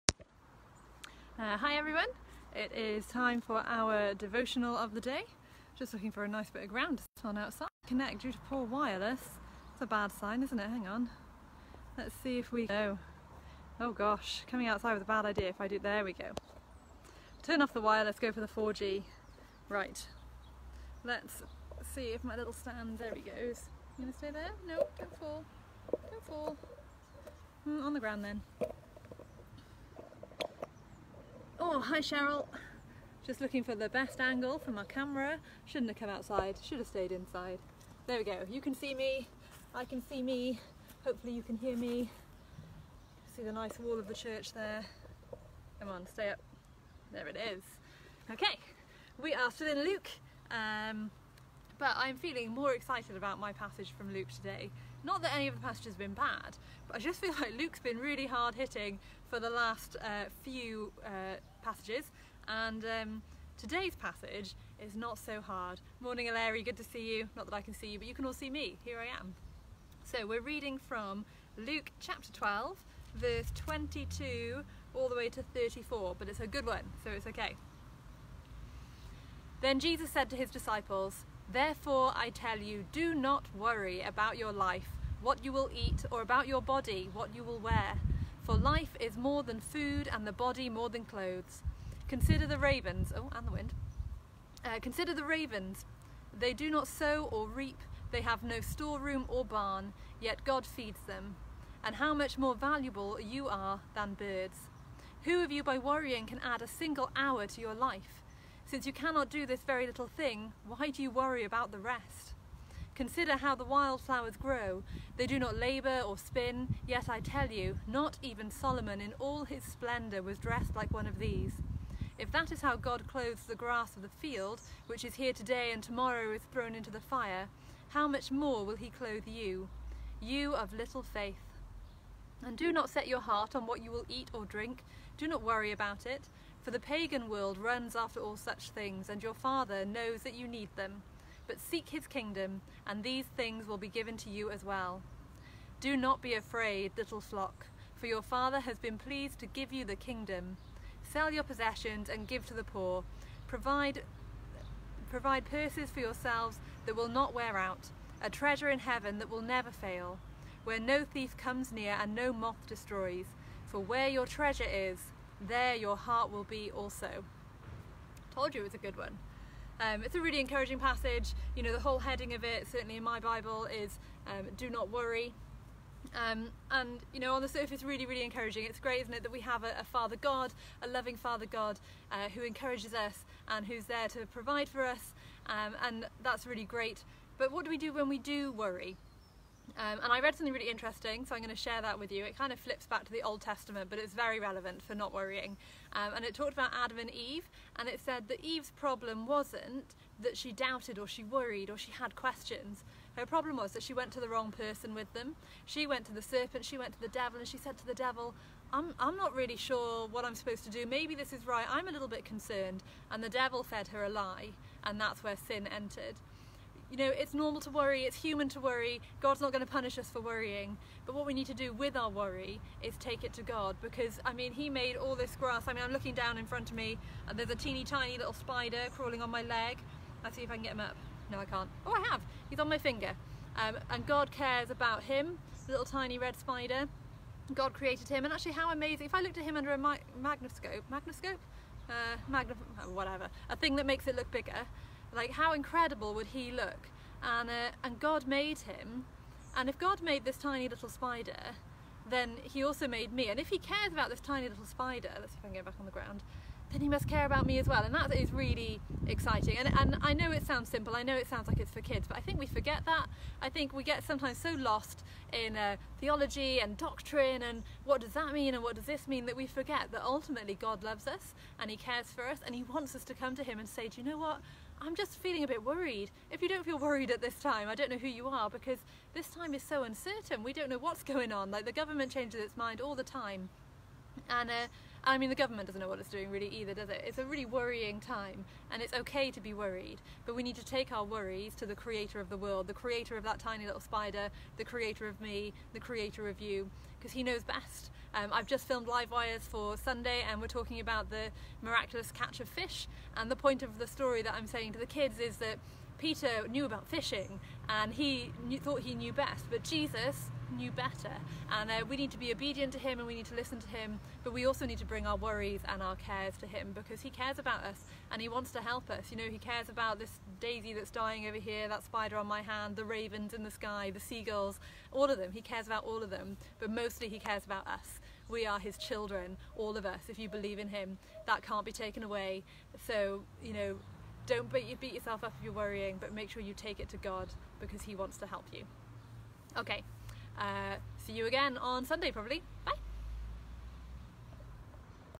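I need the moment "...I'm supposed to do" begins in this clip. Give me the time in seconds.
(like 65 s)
210 s.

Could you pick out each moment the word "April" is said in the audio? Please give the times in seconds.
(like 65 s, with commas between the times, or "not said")
not said.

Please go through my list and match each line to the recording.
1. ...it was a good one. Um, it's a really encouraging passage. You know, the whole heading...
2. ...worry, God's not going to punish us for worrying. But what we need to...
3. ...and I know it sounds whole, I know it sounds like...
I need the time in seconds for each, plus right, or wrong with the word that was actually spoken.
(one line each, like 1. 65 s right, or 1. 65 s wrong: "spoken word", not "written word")
1. 168 s right
2. 218 s right
3. 259 s wrong: "simple", not "whole".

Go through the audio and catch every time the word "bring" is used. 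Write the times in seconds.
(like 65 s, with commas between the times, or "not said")
314 s.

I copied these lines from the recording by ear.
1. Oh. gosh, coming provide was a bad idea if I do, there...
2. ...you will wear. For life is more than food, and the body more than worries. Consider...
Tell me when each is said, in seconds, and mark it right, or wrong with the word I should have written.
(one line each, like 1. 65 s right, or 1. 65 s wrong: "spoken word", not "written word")
1. 13 s wrong: "outside", not "provide"
2. 87 s wrong: "clothes", not "worries".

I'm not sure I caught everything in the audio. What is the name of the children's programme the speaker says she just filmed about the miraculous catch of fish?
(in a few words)
Live Wires.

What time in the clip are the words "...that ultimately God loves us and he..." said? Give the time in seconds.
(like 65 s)
269 s.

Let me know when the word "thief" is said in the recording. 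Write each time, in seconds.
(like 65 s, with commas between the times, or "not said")
161 s.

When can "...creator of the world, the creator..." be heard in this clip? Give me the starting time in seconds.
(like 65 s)
291 s.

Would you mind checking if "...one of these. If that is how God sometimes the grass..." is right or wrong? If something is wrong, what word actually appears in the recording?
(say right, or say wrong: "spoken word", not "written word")
wrong: "clothes", not "sometimes".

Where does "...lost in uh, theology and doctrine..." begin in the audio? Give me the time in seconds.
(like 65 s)
264 s.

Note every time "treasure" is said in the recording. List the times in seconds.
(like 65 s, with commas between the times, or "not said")
158 s, 164 s.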